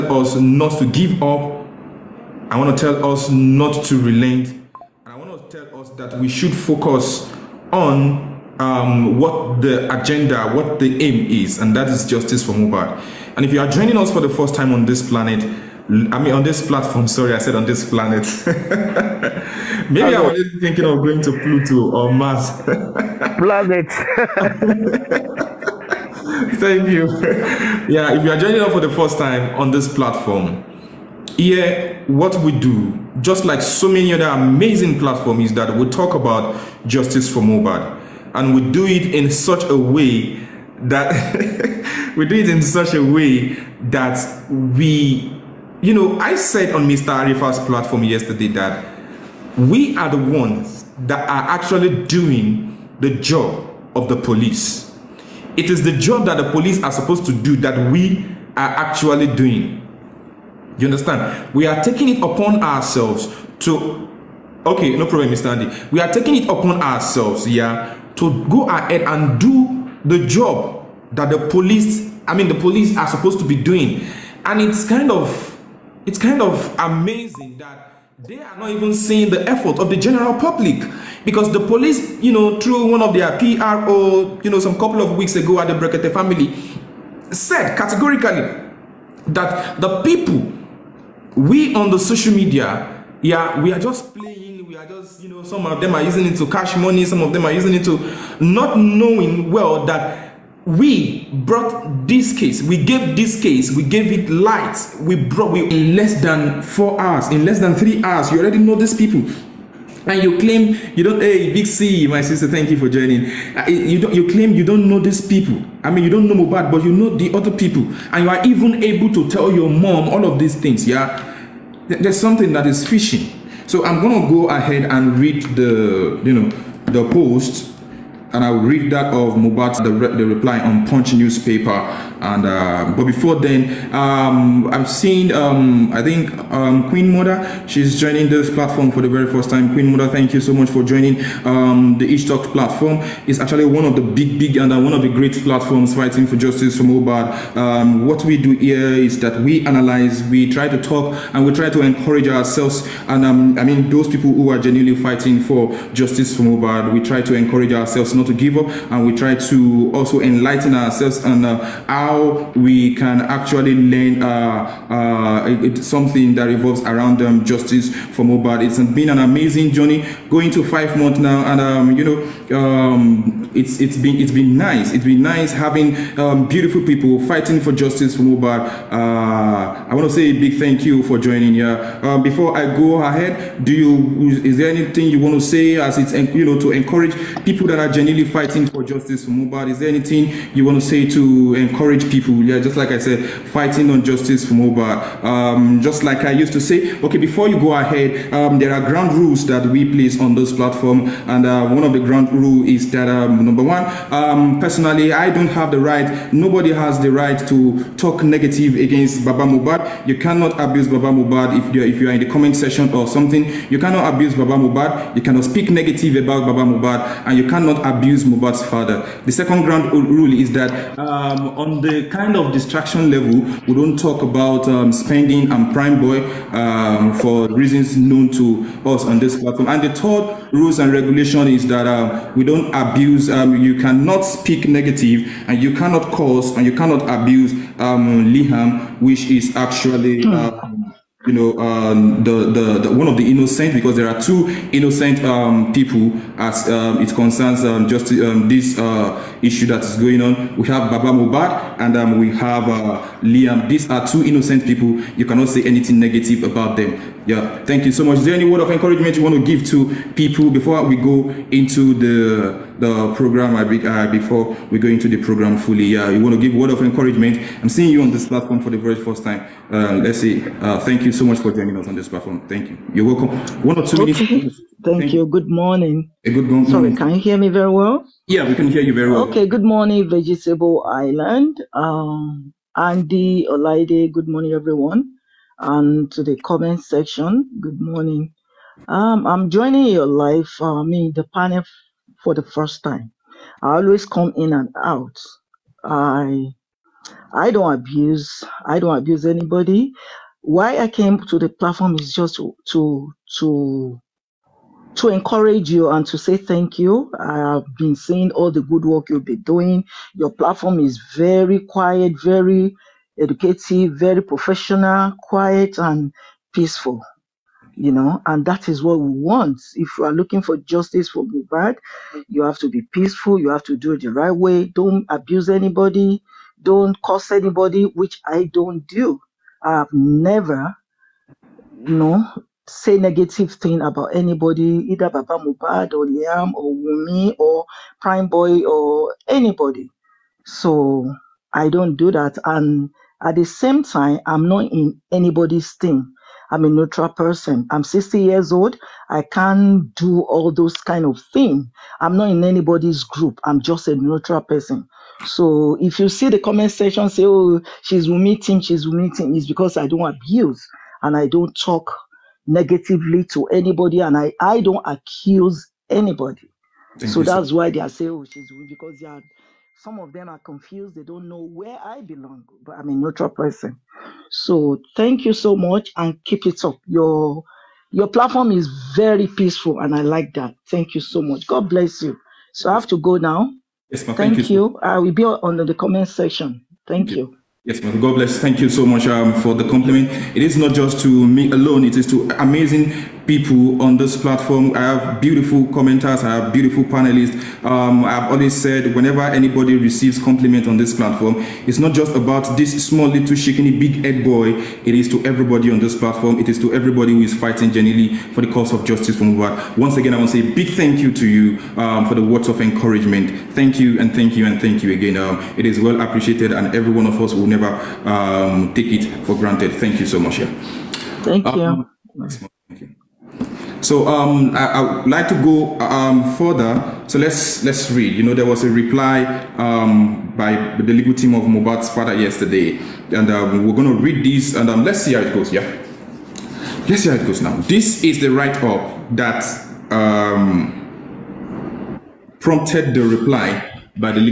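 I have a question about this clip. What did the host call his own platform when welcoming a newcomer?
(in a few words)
Each Talk.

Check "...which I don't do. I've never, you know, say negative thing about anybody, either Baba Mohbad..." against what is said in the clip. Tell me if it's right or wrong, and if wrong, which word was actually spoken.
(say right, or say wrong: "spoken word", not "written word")
right.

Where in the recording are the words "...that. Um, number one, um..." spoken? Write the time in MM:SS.
03:22.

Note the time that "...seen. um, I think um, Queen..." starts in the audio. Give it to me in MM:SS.
02:14.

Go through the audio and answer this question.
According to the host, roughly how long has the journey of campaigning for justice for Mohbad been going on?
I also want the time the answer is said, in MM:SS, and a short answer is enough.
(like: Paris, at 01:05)
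5 months, at 02:50.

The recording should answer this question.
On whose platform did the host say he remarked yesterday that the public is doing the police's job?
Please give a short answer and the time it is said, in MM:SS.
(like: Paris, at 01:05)
Mr. Arifa's platform, at 00:46.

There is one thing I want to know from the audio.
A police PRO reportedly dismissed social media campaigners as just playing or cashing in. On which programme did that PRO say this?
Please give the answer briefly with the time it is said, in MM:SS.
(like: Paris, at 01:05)
Brekete Family, at 01:25.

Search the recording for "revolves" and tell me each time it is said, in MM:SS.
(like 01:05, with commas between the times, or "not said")
02:46.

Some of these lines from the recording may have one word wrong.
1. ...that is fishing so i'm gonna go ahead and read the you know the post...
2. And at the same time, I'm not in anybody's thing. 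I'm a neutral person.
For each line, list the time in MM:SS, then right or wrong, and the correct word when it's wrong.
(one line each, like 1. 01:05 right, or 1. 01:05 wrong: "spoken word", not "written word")
1. 02:02 right
2. 05:42 right.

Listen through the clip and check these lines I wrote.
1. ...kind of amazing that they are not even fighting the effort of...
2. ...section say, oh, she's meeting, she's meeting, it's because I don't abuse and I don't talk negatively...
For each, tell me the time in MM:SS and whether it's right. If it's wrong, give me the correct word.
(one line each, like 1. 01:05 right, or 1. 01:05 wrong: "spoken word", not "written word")
1. 01:16 wrong: "seeing", not "fighting"
2. 05:56 right.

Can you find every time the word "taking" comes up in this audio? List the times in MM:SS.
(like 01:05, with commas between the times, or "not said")
01:01, 01:06.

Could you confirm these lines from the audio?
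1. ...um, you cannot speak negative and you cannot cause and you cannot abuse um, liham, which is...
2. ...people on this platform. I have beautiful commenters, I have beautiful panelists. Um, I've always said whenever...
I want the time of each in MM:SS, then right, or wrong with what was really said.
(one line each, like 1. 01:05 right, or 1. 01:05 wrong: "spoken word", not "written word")
1. 03:53 right
2. 06:33 right.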